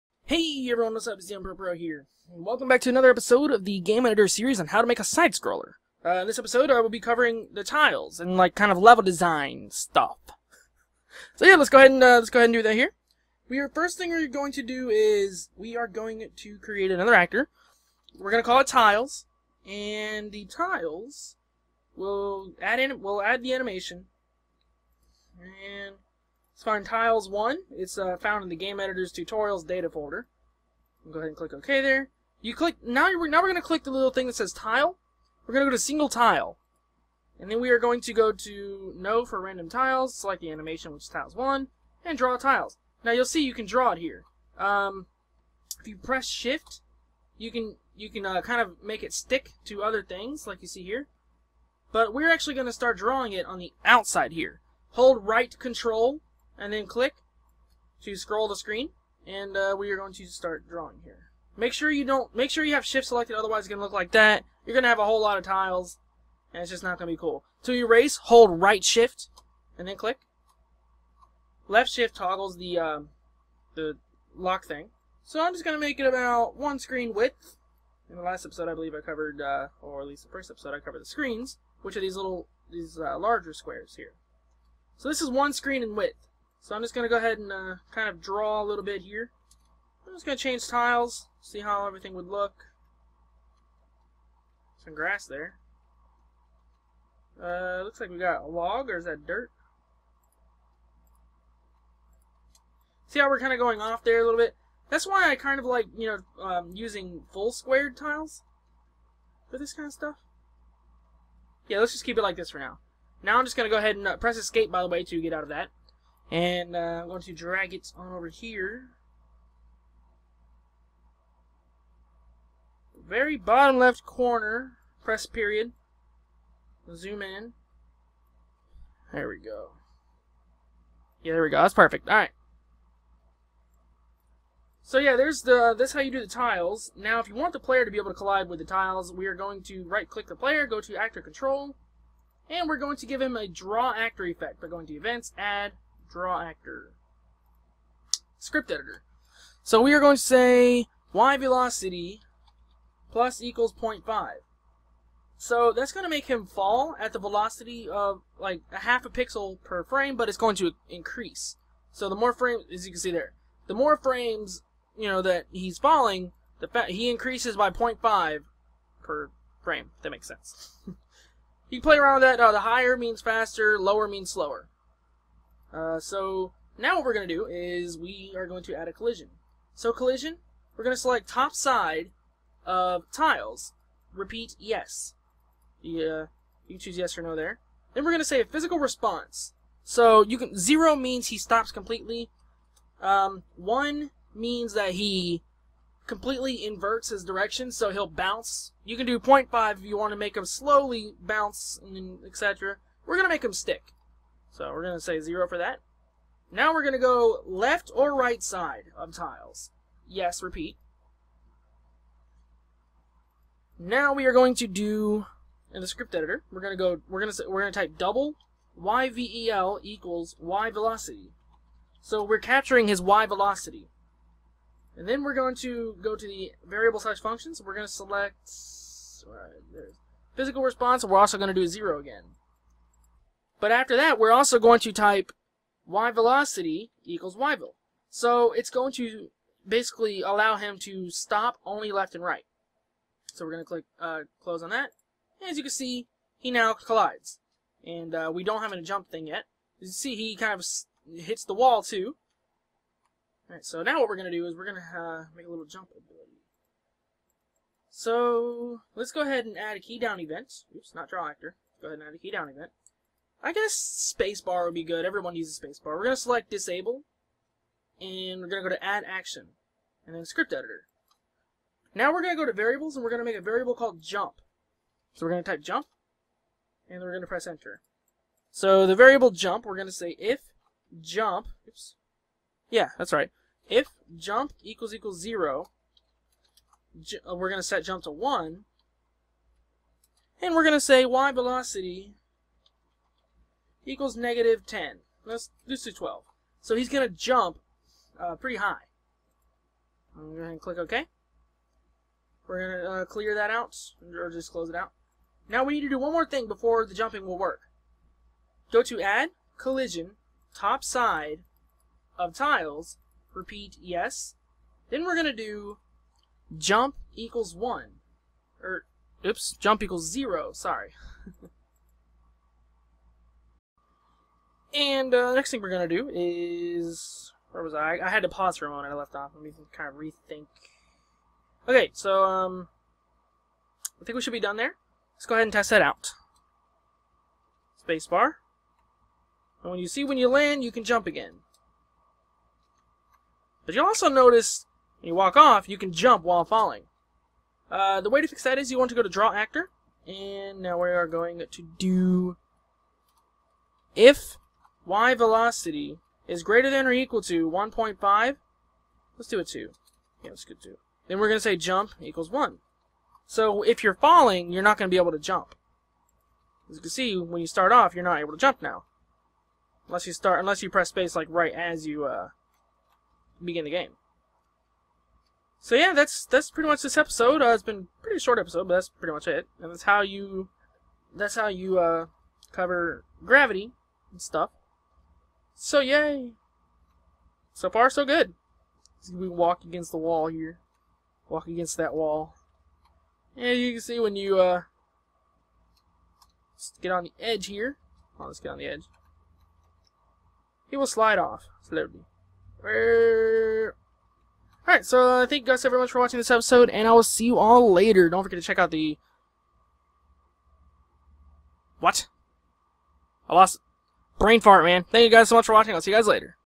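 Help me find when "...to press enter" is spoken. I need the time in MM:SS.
04:37.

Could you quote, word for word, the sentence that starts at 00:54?
Hold right control and then click to scroll the screen, and uh, we are going to start drawing here.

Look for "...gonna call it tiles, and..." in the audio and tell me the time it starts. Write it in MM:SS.
00:18.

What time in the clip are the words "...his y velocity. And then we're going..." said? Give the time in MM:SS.
03:42.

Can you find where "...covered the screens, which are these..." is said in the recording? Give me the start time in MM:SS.
01:20.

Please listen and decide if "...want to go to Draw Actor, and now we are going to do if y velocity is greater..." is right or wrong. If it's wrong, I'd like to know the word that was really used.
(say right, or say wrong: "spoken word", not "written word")
right.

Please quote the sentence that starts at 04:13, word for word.
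Alright, so now what we're going to do is we're going to uh, make a little jump ability.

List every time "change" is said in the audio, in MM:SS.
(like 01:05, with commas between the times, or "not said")
01:30.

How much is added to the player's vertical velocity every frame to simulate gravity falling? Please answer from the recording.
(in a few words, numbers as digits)
0.5.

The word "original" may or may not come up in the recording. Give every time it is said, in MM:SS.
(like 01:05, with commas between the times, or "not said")
not said.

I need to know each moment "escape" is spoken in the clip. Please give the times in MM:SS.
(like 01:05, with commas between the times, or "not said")
01:54.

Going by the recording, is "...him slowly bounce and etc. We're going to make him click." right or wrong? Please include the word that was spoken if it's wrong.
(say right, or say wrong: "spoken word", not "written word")
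wrong: "stick", not "click".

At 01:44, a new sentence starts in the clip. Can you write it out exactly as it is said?
That's why I kind of like, you know, um, using full squared tiles for this kind of stuff.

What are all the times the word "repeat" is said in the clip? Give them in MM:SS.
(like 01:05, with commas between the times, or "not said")
03:04, 03:30, 05:13.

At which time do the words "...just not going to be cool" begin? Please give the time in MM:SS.
01:06.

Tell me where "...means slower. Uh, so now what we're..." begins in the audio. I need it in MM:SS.
02:54.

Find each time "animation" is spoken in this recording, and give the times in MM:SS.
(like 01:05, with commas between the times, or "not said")
00:23, 00:40.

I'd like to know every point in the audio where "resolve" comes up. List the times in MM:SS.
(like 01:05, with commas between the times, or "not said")
not said.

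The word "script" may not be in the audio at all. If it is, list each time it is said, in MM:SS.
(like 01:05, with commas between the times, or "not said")
02:28, 03:35, 04:30.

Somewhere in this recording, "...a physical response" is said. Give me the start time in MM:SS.
03:08.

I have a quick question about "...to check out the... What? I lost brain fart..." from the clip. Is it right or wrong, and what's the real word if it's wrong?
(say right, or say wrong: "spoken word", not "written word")
right.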